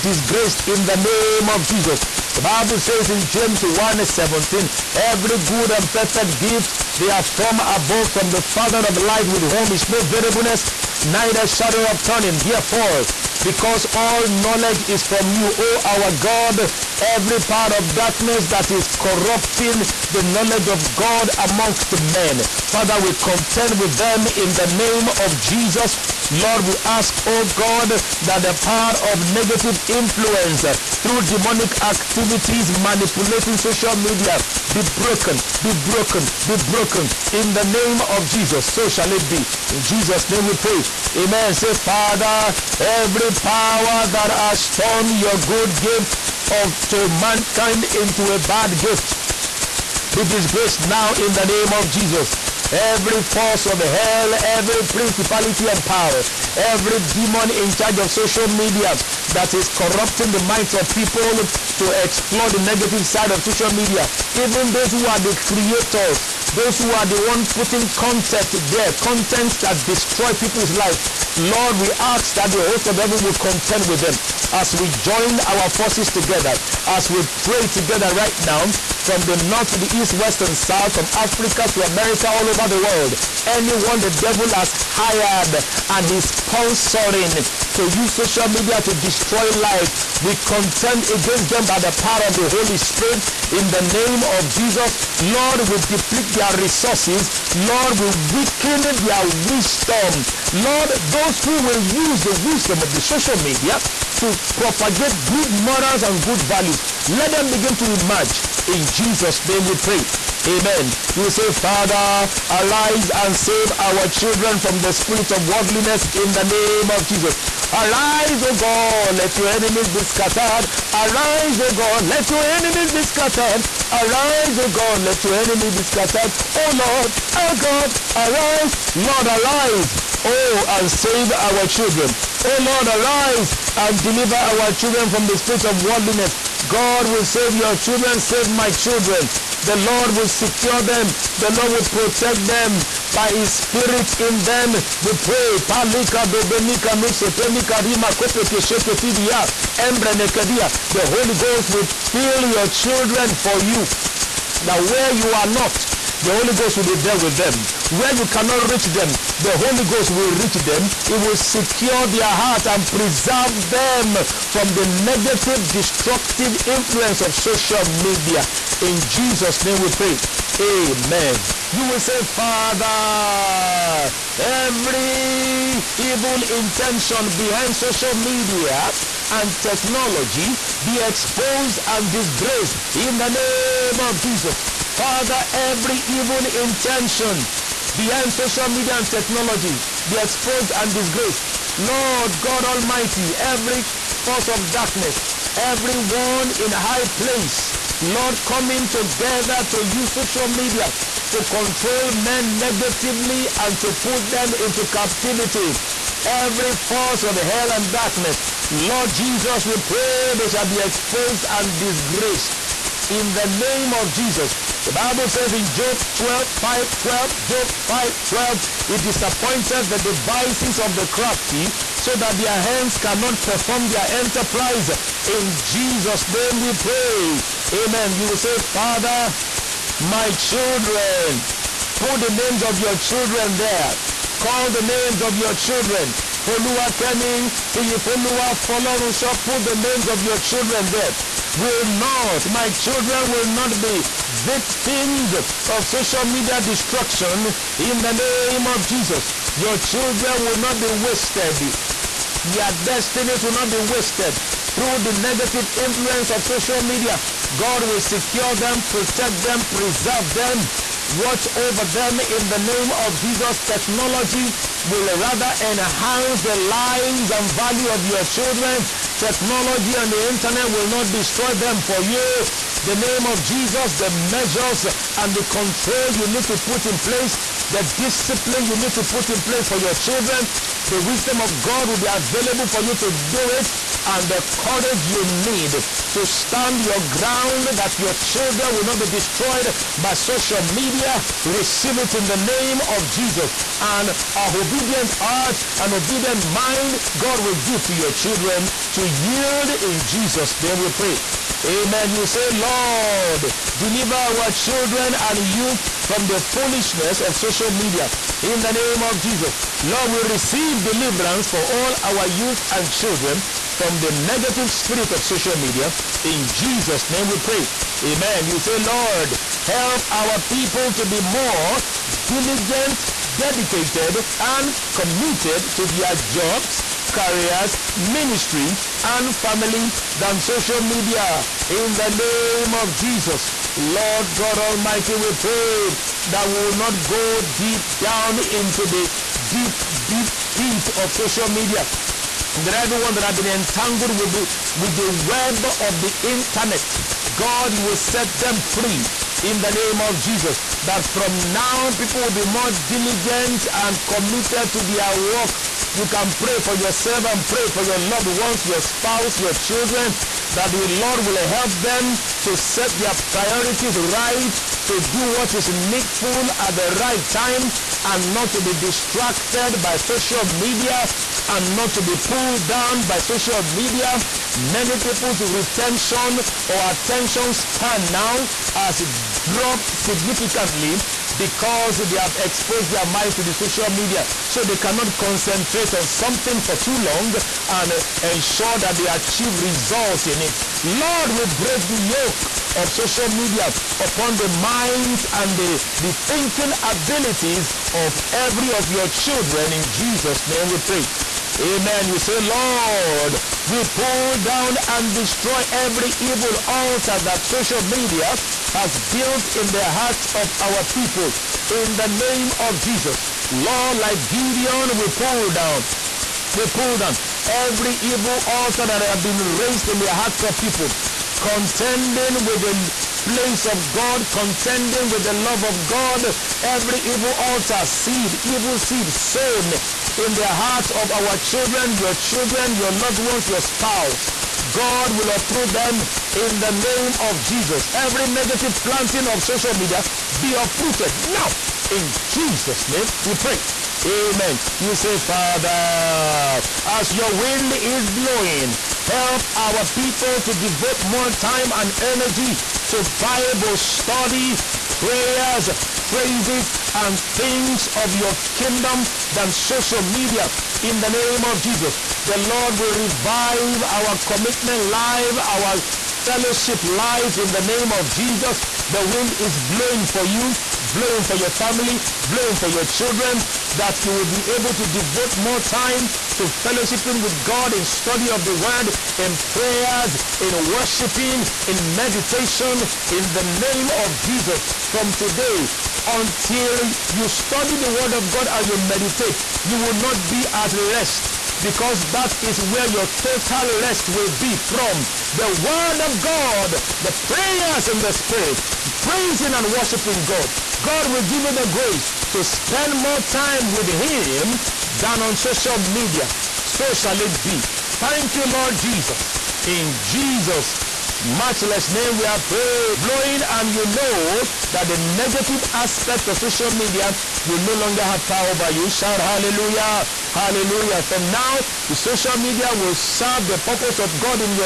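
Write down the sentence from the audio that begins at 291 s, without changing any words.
Receive it in the name of Jesus.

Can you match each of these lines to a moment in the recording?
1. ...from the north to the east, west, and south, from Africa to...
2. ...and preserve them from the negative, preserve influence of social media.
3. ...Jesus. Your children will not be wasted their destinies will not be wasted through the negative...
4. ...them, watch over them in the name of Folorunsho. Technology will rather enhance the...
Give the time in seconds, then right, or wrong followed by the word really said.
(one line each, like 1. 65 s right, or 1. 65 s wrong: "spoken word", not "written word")
1. 79 s right
2. 162 s wrong: "destructive", not "preserve"
3. 248 s right
4. 260 s wrong: "Jesus", not "Folorunsho".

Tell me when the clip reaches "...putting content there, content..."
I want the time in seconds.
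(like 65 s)
67 s.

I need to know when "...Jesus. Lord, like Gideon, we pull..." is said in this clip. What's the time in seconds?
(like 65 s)
412 s.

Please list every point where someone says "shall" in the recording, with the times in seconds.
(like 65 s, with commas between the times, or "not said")
38 s, 210 s, 506 s.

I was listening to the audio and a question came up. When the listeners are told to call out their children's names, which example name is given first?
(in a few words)
Folua Kemi.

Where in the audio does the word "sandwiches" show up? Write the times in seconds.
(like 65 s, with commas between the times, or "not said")
not said.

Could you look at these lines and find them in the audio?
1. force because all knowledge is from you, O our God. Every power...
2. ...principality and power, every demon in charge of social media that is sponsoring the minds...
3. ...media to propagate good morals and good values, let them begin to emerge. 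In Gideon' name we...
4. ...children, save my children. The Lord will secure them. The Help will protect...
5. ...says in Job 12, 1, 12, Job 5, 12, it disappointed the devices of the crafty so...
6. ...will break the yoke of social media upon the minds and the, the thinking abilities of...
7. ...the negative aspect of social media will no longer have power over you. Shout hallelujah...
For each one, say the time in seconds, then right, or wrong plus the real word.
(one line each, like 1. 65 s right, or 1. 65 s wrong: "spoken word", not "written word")
1. 12 s right
2. 54 s wrong: "corrupting", not "sponsoring"
3. 103 s wrong: "Jesus", not "Gideon"
4. 137 s wrong: "Lord", not "Help"
5. 215 s wrong: "5", not "1"
6. 391 s right
7. 514 s right.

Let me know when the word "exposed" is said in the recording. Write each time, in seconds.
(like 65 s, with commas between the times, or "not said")
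181 s, 190 s, 210 s, 382 s.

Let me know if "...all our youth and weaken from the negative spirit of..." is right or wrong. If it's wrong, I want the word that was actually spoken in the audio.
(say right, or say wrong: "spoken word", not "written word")
wrong: "children", not "weaken".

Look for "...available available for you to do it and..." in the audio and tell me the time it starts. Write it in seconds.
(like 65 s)
282 s.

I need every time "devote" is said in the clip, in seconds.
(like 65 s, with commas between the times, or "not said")
450 s, 474 s.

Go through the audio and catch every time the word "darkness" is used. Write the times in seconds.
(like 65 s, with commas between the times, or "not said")
17 s, 194 s, 207 s.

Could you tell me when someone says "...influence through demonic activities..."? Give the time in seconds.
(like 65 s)
29 s.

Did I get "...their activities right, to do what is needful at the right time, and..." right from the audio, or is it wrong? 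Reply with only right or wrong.
wrong.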